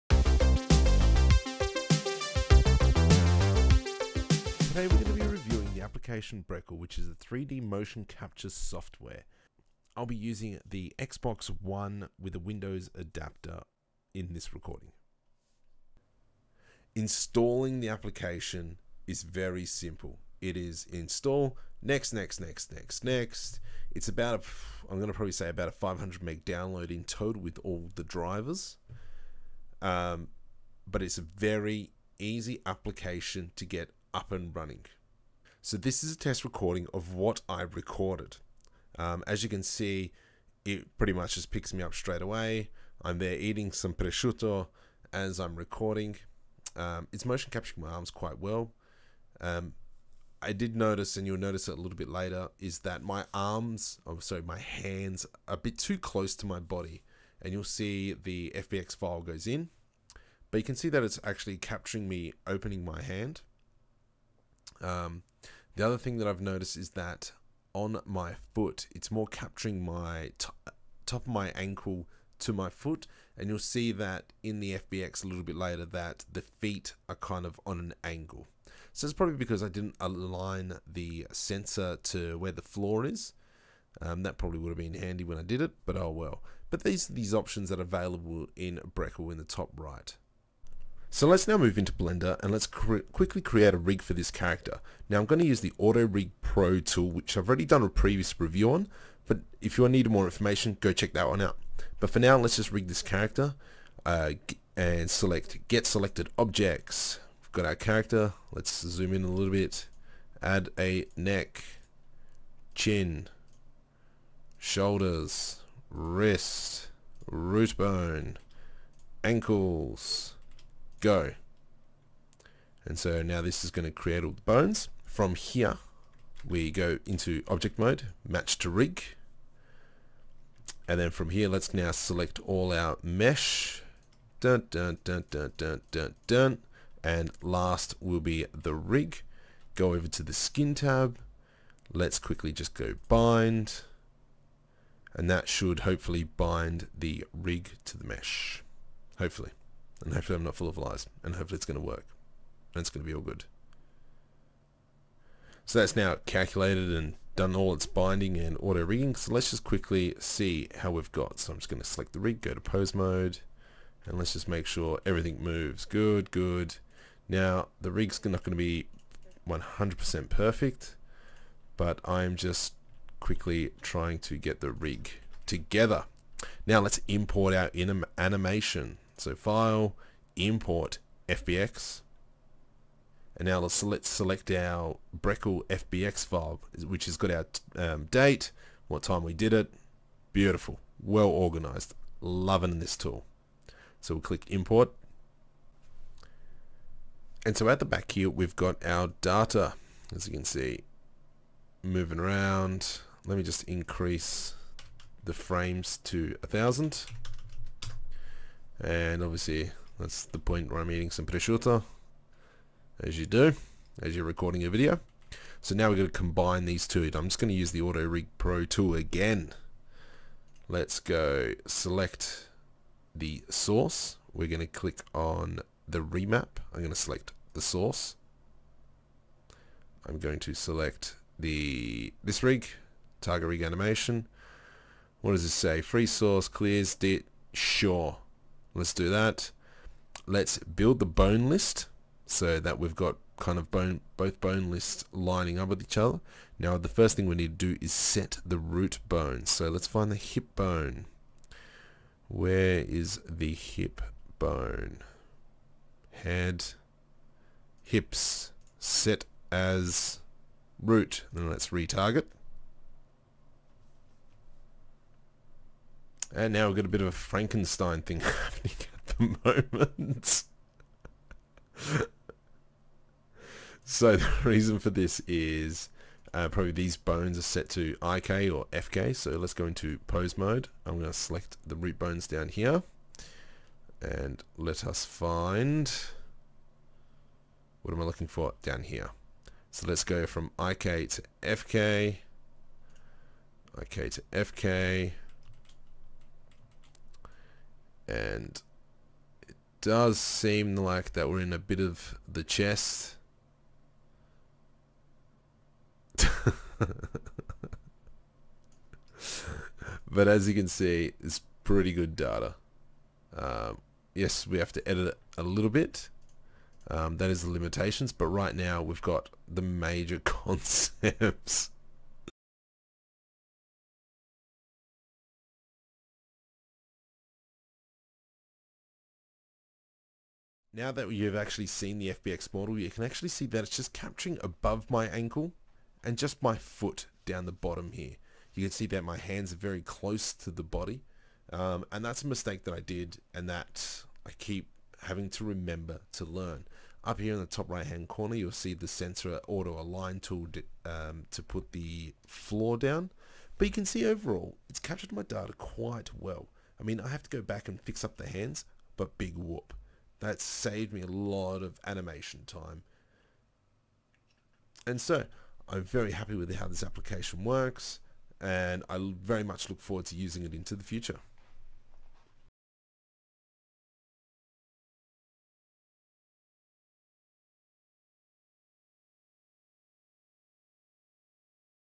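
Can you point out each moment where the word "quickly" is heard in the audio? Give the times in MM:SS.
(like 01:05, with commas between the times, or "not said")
01:32, 02:22, 02:39, 02:53.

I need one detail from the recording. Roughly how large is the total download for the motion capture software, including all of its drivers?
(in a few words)
500 meg.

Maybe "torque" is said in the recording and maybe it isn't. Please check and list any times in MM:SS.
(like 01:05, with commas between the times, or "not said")
not said.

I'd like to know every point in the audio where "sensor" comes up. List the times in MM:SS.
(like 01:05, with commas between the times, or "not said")
01:21, 05:48.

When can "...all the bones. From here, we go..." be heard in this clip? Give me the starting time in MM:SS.
02:04.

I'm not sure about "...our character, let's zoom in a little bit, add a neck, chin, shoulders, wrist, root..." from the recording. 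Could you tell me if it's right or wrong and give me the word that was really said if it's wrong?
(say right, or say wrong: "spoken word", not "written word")
right.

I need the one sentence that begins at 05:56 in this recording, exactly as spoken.
I mean I have to go back and fix up the hands but big whoop.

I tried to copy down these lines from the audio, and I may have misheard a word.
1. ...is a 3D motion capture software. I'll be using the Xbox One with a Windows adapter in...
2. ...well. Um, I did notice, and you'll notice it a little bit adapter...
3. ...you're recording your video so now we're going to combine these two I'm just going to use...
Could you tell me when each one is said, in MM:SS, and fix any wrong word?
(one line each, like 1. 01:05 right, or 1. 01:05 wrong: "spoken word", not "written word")
1. 00:06 right
2. 00:48 wrong: "later", not "adapter"
3. 03:34 right.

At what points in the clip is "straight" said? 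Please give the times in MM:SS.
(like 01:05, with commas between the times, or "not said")
00:41.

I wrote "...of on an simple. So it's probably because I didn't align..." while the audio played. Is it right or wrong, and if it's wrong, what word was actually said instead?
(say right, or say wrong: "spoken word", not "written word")
wrong: "angle", not "simple".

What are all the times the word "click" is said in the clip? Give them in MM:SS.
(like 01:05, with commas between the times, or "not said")
03:14, 03:44.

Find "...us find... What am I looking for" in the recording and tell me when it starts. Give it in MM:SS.
04:44.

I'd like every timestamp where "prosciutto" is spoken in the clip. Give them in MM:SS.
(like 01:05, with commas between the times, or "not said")
00:43, 03:31.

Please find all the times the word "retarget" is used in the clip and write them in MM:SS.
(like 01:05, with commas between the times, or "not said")
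04:21.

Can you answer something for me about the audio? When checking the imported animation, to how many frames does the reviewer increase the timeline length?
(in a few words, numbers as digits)
1000.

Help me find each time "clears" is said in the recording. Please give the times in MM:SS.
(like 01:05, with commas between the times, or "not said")
03:56.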